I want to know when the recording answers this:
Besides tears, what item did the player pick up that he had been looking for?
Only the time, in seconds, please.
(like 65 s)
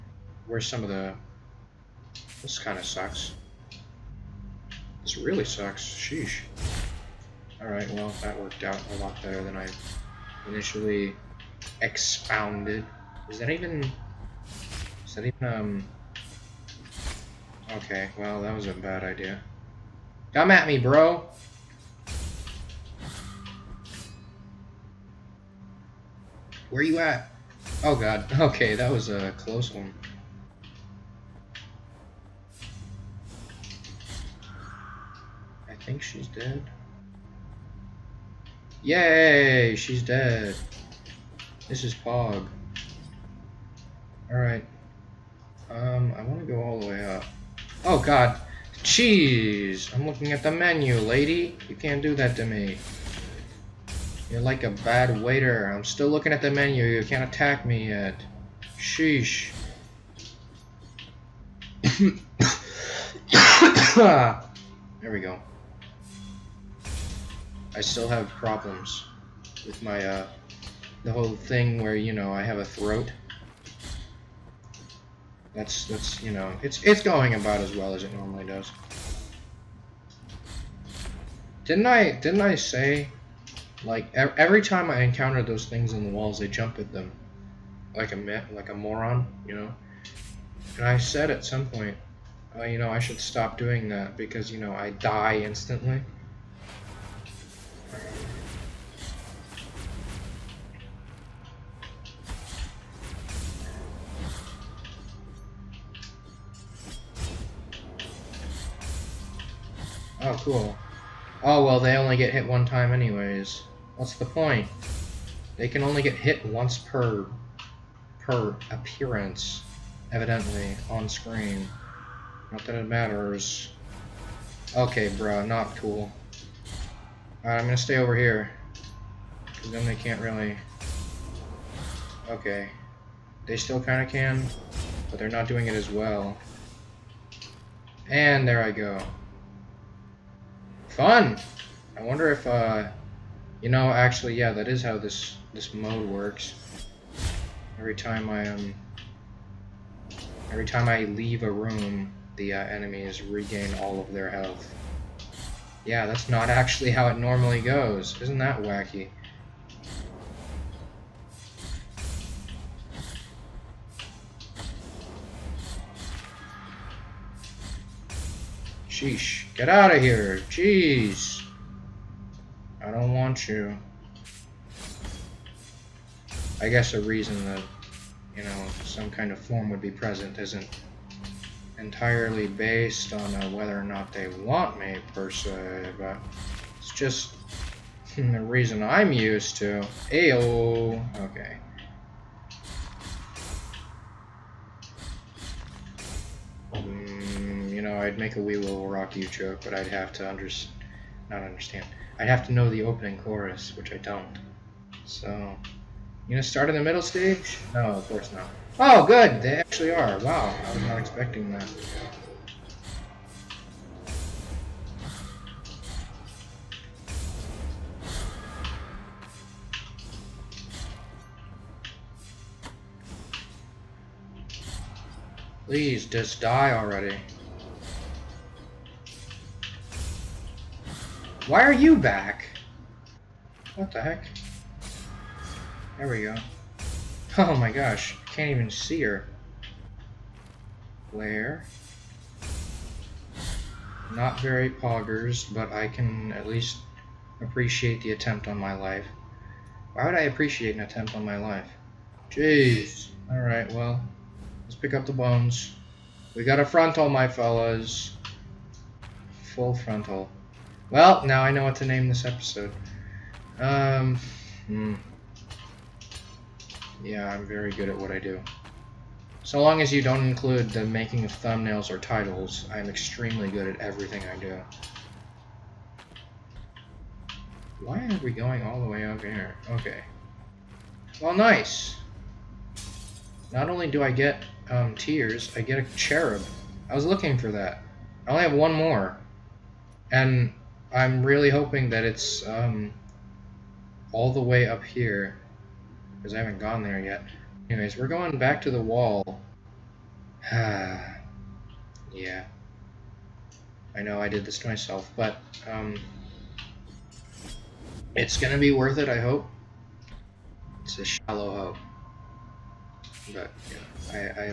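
285 s.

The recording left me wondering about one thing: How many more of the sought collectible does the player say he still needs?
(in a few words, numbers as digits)
1.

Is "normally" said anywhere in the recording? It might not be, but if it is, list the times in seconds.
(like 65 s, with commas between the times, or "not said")
78 s, 157 s.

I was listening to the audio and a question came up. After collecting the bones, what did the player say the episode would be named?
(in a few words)
Full frontal.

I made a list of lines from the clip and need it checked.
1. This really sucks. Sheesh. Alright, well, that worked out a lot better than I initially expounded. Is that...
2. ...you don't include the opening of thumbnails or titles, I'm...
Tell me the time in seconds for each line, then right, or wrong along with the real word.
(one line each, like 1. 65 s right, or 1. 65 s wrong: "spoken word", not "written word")
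1. 5 s right
2. 269 s wrong: "making", not "opening".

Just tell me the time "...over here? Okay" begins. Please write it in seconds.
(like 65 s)
279 s.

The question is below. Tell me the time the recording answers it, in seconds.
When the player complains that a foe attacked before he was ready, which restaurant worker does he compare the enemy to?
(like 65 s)
54 s.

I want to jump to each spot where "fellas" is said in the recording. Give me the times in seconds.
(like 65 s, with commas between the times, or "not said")
257 s.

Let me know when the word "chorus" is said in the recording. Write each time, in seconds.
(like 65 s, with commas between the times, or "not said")
203 s.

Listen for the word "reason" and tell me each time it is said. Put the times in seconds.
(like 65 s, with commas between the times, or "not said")
177 s, 188 s.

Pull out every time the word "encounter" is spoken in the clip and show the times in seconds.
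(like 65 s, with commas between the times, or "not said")
85 s.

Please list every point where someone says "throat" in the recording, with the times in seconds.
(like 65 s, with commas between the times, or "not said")
72 s.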